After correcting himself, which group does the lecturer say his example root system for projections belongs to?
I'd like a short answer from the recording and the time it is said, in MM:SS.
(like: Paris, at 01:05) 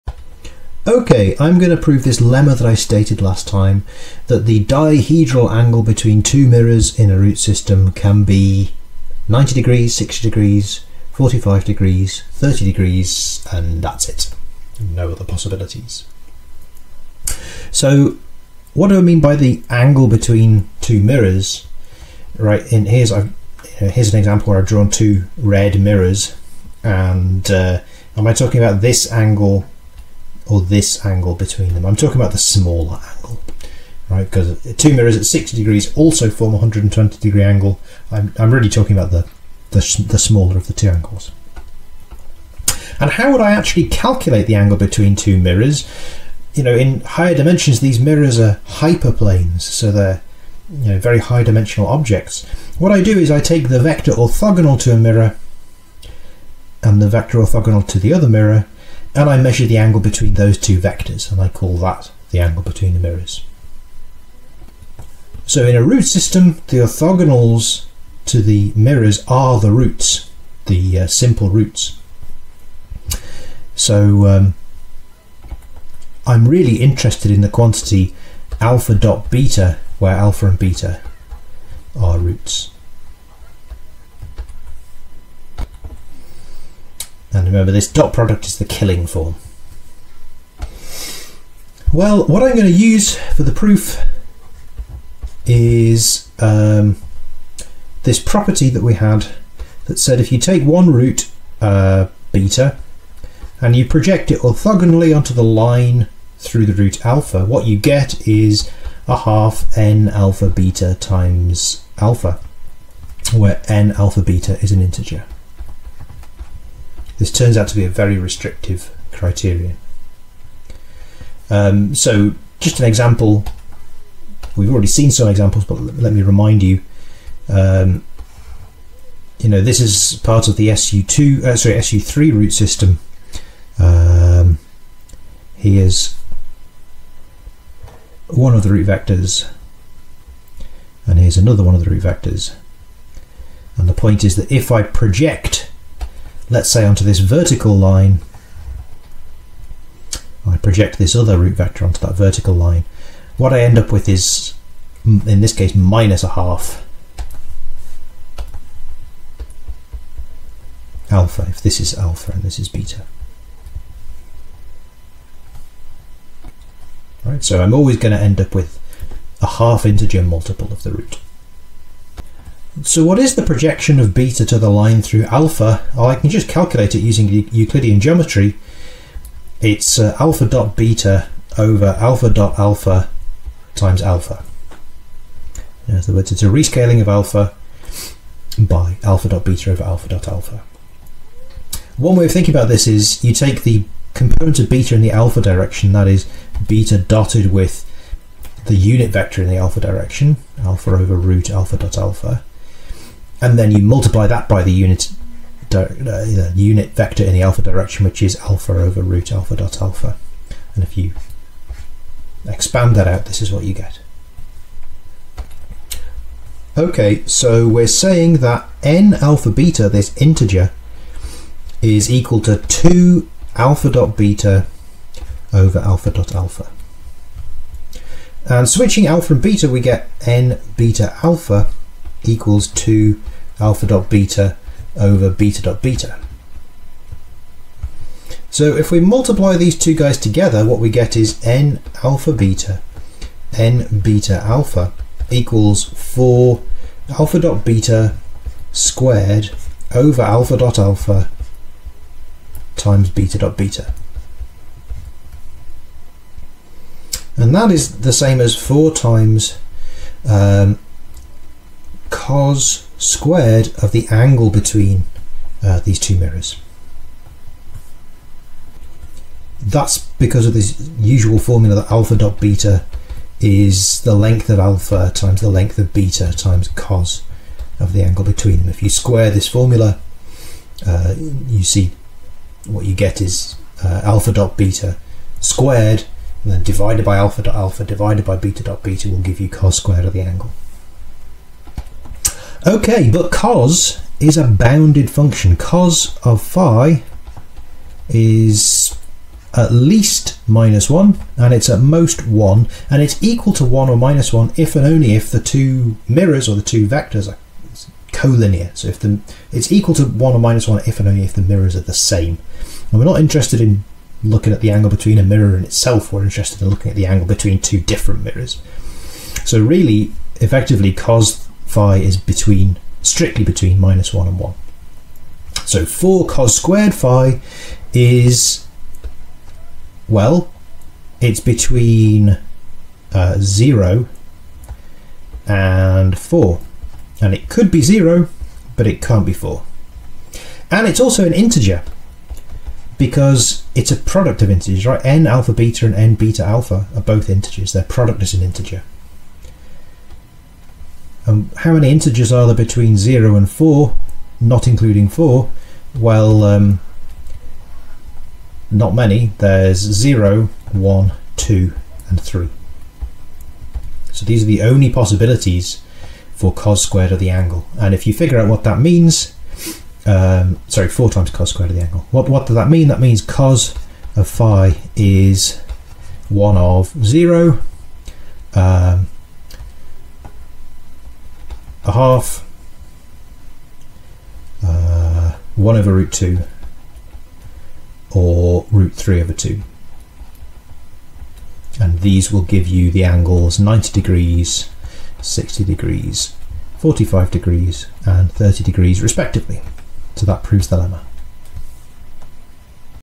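SU3, at 02:11.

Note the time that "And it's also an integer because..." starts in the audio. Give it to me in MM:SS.
05:40.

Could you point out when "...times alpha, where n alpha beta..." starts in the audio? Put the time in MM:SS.
01:51.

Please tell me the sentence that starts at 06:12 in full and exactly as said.
That means cos of phi is 1 of 0 a half, uh, 1 over root 2, or root 3 over 2.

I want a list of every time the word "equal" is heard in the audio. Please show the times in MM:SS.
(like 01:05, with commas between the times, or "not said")
03:42, 03:52, 04:05, 05:03, 05:09.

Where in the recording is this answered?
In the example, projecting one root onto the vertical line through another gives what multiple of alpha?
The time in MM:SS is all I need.
02:35.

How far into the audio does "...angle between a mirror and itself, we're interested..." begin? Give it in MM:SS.
05:14.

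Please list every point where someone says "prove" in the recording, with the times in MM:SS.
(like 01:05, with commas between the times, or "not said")
00:01, 06:40.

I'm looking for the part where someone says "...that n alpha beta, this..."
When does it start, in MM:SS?
03:38.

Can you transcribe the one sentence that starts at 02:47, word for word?
Right, so I'm always going to end up with a half integer multiple of the root.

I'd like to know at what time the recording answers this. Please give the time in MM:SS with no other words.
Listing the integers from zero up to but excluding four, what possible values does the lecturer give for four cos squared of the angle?
05:59.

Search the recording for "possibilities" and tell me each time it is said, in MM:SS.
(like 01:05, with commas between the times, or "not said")
00:15, 06:04.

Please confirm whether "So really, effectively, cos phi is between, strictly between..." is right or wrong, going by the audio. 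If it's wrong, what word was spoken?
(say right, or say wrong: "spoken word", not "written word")
right.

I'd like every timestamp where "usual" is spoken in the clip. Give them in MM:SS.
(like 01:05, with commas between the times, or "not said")
04:30.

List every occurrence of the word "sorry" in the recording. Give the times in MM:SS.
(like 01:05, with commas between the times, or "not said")
02:11, 06:10.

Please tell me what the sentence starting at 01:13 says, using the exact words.
So um, I'm really interested in the quantity alpha dot beta where alpha and beta are roots.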